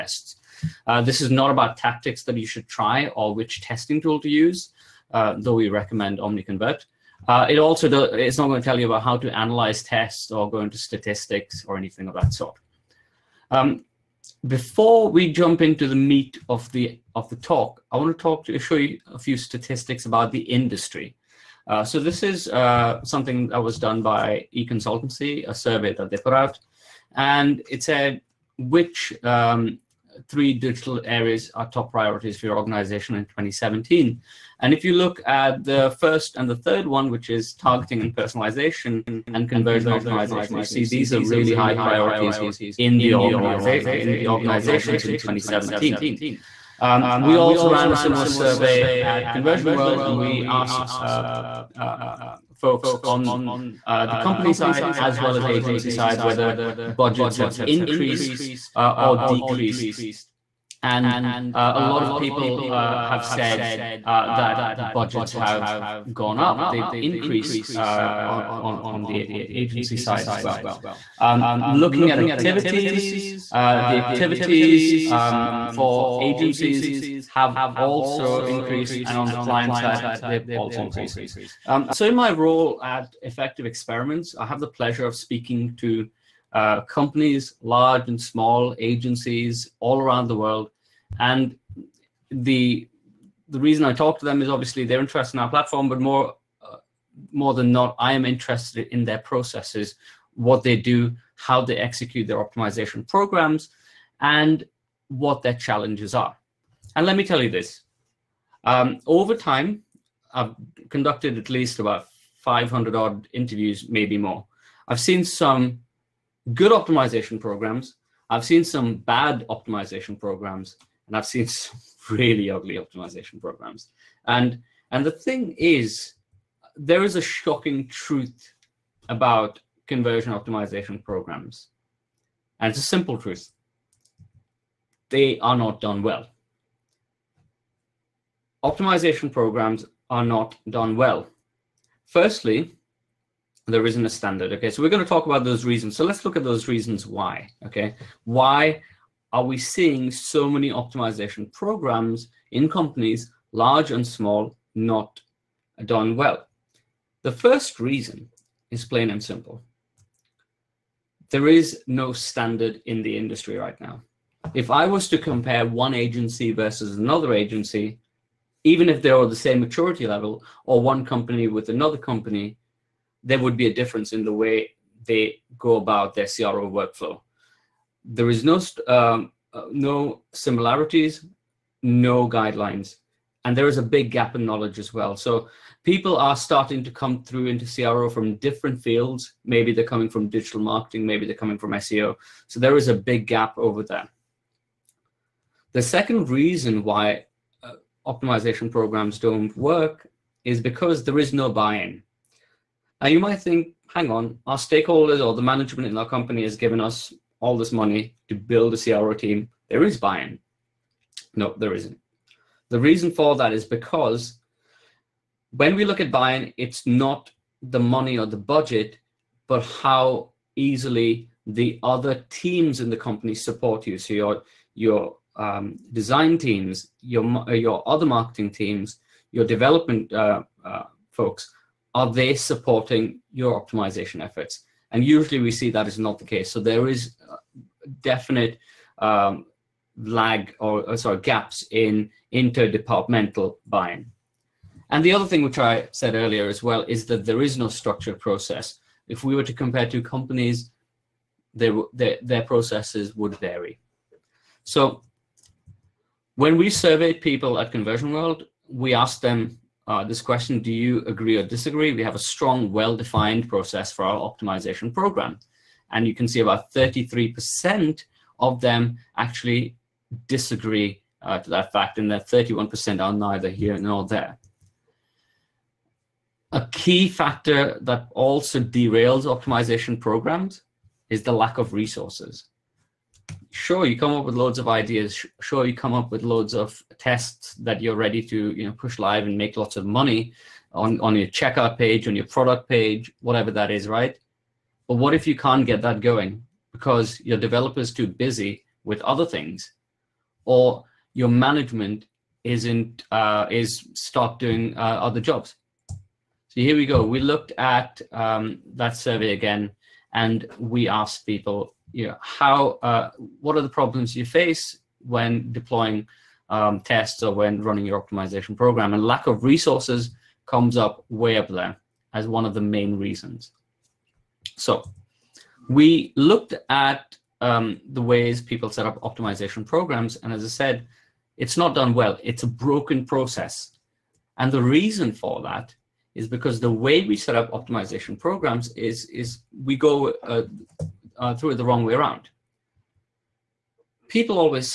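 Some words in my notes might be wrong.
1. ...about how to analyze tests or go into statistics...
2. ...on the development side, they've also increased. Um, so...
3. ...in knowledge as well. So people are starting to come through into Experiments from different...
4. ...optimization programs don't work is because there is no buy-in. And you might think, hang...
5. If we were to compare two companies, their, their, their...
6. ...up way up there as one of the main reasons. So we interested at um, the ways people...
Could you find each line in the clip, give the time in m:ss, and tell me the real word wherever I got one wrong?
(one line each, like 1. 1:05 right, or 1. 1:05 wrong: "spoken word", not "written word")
1. 0:08 right
2. 1:19 wrong: "client", not "development"
3. 3:04 wrong: "CRO", not "Experiments"
4. 3:18 right
5. 4:09 right
6. 5:20 wrong: "looked", not "interested".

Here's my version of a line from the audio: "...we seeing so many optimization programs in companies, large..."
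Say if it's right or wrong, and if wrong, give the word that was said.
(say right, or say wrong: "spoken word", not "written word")
right.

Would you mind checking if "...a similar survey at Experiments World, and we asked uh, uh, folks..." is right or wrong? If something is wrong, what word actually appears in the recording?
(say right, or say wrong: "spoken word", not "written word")
wrong: "Conversion", not "Experiments".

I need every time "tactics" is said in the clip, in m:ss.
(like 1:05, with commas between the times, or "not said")
0:01.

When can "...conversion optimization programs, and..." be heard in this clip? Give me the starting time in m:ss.
2:09.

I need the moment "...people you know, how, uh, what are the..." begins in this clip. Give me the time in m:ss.
5:11.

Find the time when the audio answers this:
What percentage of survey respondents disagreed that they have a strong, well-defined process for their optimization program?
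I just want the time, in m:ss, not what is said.
4:26.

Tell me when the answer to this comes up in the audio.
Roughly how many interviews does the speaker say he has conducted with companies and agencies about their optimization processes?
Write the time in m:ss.
1:52.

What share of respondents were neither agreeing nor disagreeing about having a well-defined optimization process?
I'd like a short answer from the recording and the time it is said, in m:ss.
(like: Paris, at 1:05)
31%, at 4:32.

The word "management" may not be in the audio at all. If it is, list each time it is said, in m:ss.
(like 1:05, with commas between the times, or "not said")
3:25, 5:01.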